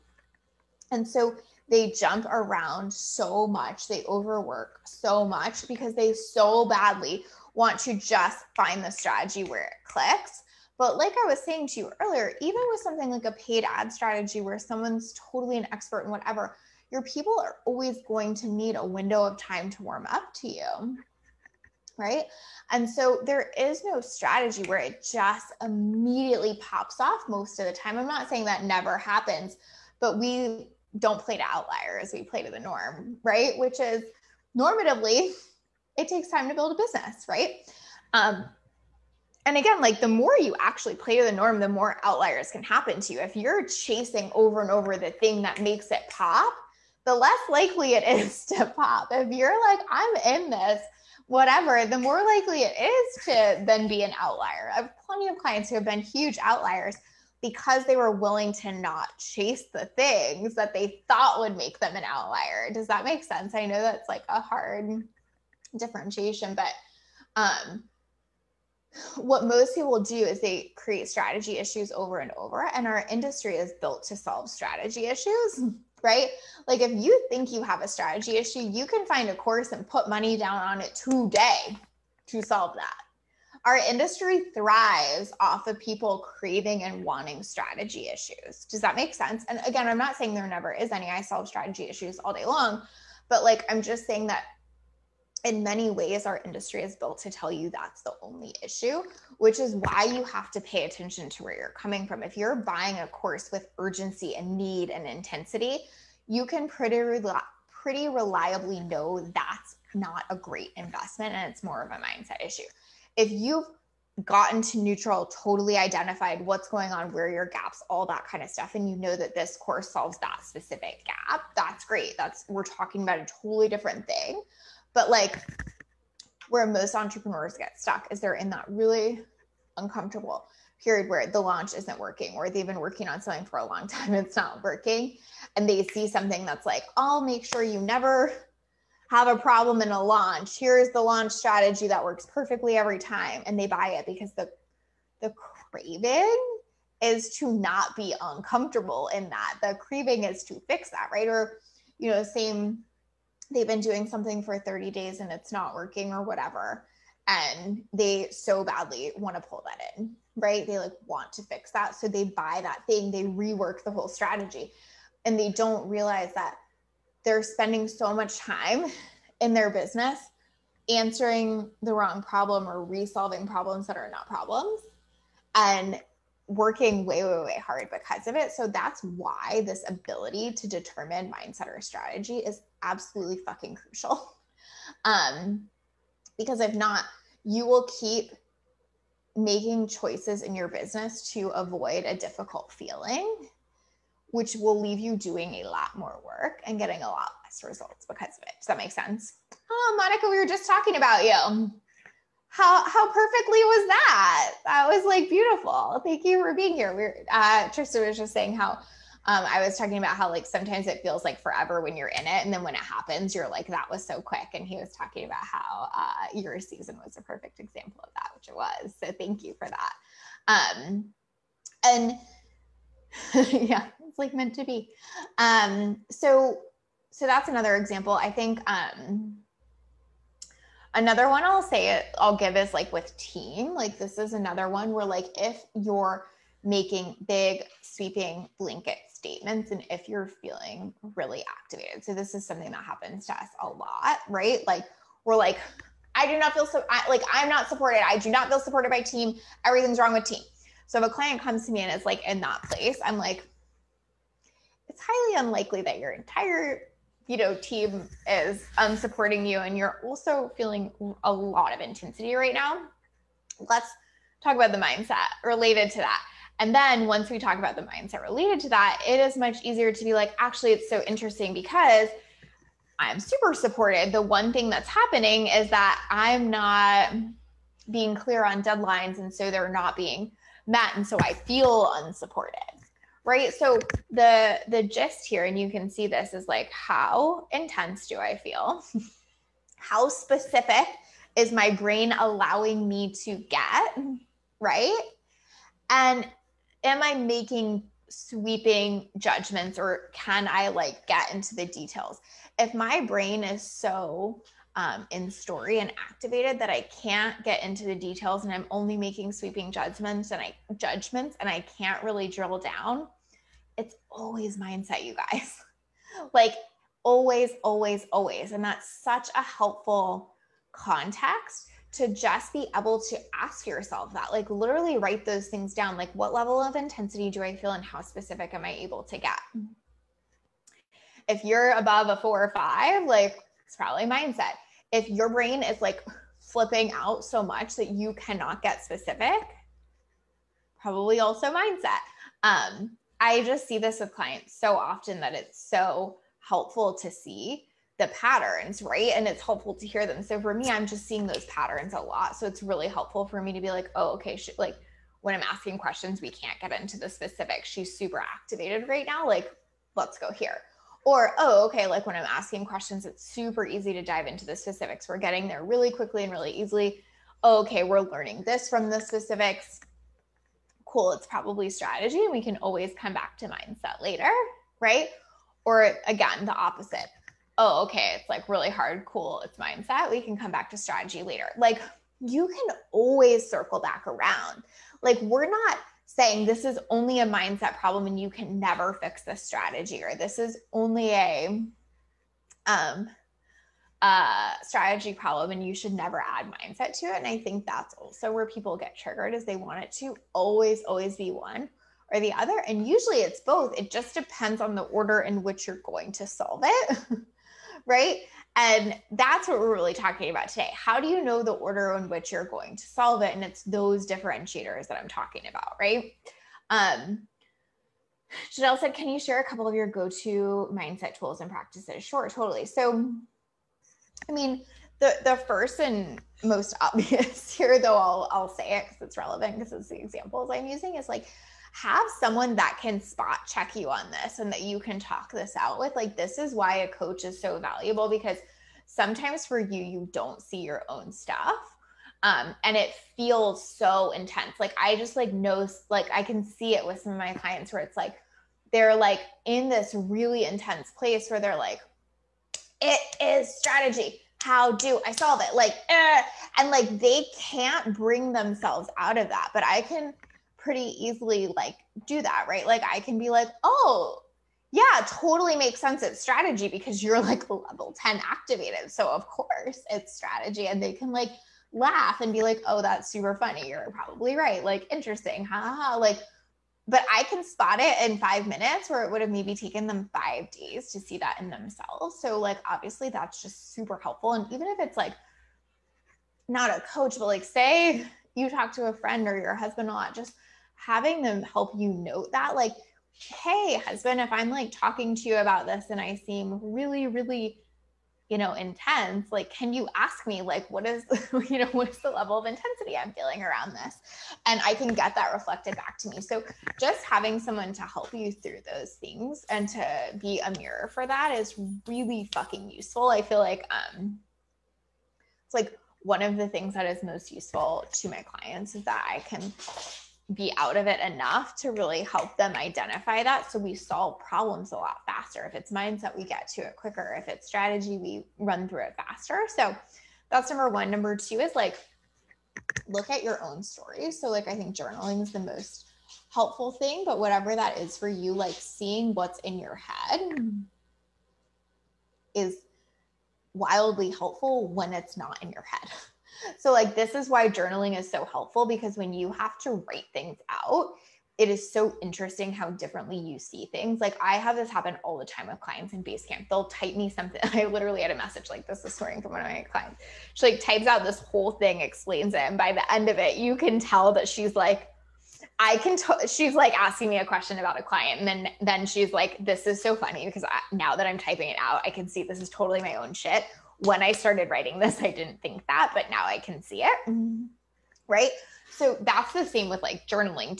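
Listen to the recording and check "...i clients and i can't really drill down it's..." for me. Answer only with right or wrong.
wrong.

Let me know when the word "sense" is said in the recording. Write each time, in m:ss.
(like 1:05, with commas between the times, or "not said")
1:03, 1:29, 3:18, 7:45.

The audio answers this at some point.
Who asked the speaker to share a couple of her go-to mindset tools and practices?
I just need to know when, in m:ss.
6:58.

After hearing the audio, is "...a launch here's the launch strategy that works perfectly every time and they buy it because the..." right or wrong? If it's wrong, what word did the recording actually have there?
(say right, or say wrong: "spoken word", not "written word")
right.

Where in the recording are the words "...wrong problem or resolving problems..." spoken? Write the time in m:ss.
2:51.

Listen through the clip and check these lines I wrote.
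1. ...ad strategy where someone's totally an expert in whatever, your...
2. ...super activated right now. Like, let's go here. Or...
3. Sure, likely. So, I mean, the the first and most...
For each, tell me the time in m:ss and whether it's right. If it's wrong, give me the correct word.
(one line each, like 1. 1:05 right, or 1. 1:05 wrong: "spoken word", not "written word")
1. 0:13 right
2. 5:57 right
3. 7:02 wrong: "totally", not "likely".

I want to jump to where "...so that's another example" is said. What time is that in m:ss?
3:47.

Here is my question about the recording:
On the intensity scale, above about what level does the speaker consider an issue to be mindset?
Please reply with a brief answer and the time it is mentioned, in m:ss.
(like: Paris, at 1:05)
4 or 5, at 5:32.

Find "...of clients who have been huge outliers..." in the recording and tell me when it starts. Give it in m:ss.
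0:55.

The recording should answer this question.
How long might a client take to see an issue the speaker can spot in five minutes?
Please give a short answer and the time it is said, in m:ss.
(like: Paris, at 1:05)
5 days, at 8:00.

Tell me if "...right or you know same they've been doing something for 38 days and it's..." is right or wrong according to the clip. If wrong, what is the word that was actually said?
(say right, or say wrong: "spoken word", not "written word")
wrong: "30", not "38".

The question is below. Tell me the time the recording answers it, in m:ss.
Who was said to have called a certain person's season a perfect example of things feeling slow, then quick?
3:27.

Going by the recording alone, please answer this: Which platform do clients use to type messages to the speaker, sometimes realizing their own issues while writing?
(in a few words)
Basecamp.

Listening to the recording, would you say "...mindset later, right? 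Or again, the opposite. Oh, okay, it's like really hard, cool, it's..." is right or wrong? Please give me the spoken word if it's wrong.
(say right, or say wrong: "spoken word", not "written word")
right.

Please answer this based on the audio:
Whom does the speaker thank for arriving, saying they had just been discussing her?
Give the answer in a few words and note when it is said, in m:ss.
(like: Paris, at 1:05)
Monica, at 3:20.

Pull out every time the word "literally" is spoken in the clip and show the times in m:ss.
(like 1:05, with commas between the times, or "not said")
5:24, 9:17.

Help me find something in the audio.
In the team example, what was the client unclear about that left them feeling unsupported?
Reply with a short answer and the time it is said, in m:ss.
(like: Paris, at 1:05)
deadlines, at 4:38.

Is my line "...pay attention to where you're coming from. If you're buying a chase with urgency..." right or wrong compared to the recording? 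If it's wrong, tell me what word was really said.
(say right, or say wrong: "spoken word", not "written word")
wrong: "course", not "chase".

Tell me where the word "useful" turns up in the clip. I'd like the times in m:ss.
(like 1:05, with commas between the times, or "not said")
8:32, 8:37.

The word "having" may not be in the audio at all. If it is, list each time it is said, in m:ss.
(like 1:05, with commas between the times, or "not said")
8:10, 8:27.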